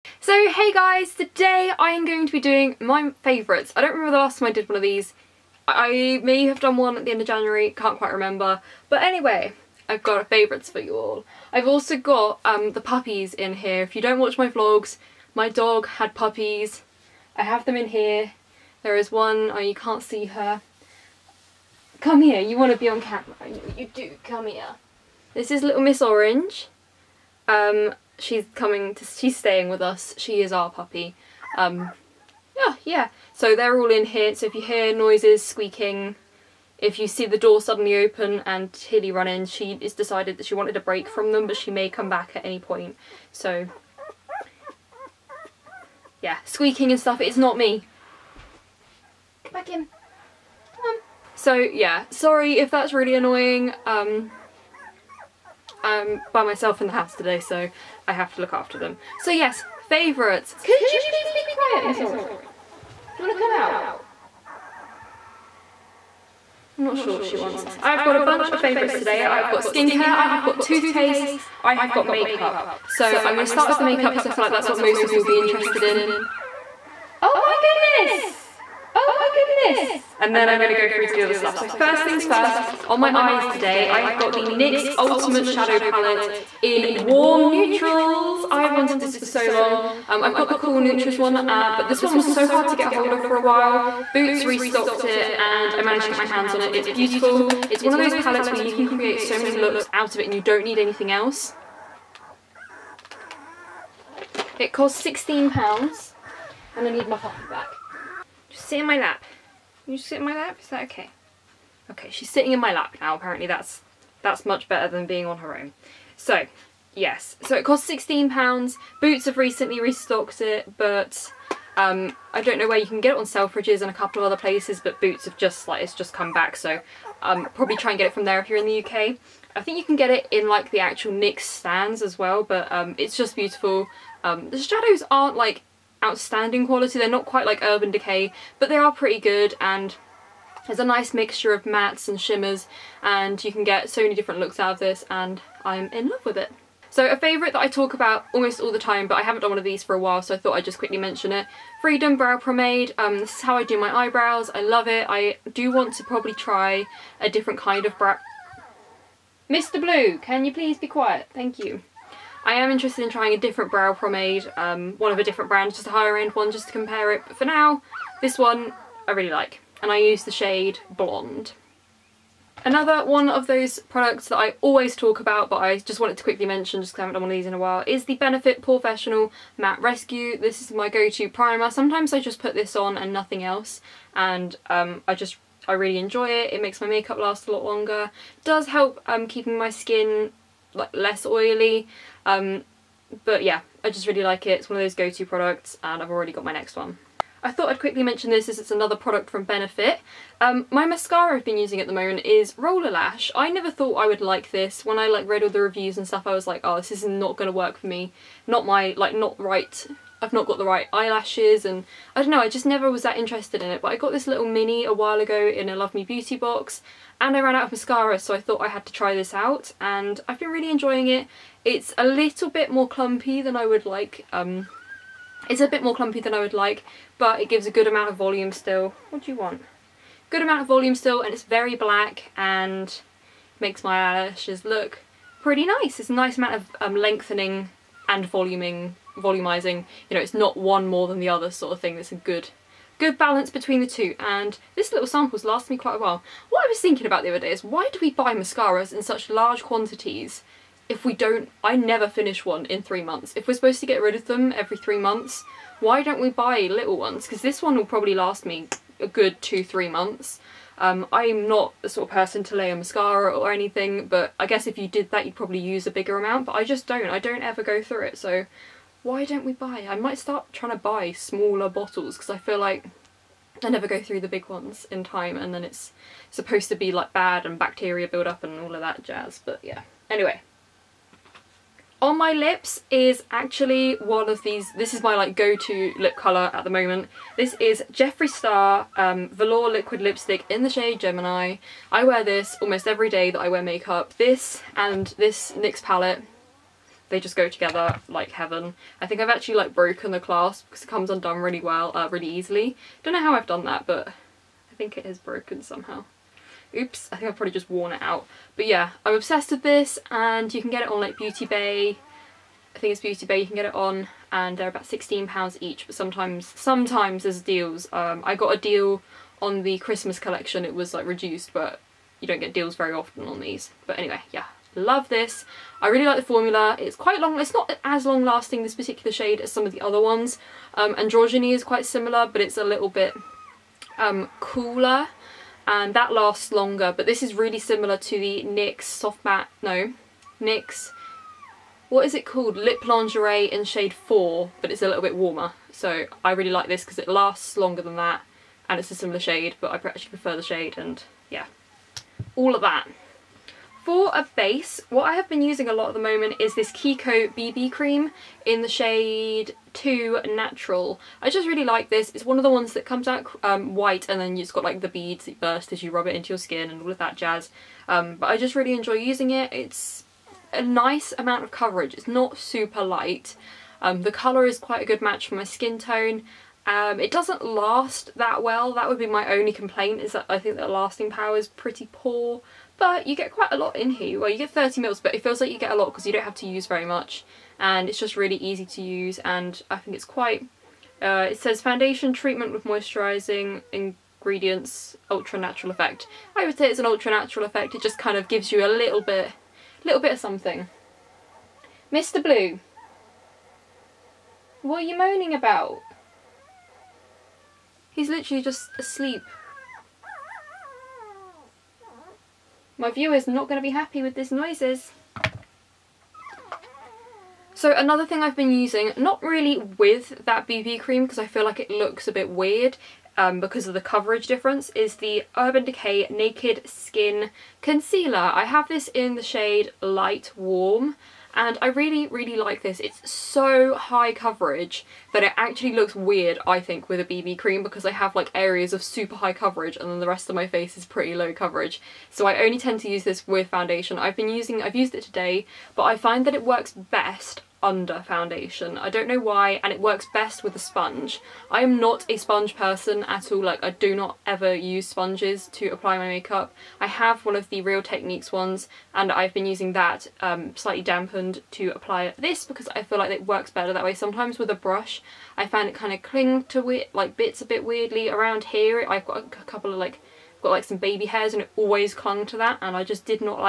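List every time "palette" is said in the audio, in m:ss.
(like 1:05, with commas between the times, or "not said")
1:25, 1:38, 4:55.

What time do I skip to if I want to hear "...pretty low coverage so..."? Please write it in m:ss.
7:20.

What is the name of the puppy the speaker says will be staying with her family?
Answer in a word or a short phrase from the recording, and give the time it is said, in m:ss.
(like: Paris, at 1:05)
Miss Orange, at 0:25.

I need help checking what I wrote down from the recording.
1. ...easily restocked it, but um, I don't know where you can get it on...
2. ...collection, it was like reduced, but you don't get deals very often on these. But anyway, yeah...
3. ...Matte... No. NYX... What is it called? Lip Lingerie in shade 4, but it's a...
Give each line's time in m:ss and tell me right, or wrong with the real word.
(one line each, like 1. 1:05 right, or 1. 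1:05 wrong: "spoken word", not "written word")
1. 1:59 wrong: "recently", not "easily"
2. 5:20 right
3. 5:39 right.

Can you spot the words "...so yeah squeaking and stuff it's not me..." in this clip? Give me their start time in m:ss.
0:43.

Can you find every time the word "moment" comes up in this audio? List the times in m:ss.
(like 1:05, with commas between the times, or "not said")
3:21, 4:46, 5:55.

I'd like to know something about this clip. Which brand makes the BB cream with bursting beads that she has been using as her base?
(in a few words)
Kiko.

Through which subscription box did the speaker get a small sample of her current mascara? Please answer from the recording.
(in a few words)
Love Me Beauty.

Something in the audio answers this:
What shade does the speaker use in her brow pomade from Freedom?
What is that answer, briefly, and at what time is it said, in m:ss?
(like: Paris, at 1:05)
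Blonde, at 2:50.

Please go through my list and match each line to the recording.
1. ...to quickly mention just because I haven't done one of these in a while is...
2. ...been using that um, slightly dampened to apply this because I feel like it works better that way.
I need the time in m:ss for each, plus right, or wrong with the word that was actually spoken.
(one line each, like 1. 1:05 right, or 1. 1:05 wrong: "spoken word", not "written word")
1. 2:56 right
2. 7:39 right.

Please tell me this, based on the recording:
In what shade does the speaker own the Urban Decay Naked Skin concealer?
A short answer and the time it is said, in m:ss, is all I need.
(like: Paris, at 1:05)
Light Warm, at 7:09.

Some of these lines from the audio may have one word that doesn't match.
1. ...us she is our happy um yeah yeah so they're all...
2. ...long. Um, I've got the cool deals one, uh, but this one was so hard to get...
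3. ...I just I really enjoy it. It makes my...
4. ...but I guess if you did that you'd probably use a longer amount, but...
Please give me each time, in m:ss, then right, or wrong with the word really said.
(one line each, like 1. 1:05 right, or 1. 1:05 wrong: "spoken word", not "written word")
1. 0:29 wrong: "puppy", not "happy"
2. 1:29 wrong: "neutrals", not "deals"
3. 3:05 right
4. 4:24 wrong: "bigger", not "longer".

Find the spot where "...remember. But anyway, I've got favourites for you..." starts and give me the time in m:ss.
0:08.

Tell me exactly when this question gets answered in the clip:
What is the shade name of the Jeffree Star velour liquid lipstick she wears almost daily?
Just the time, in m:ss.
4:50.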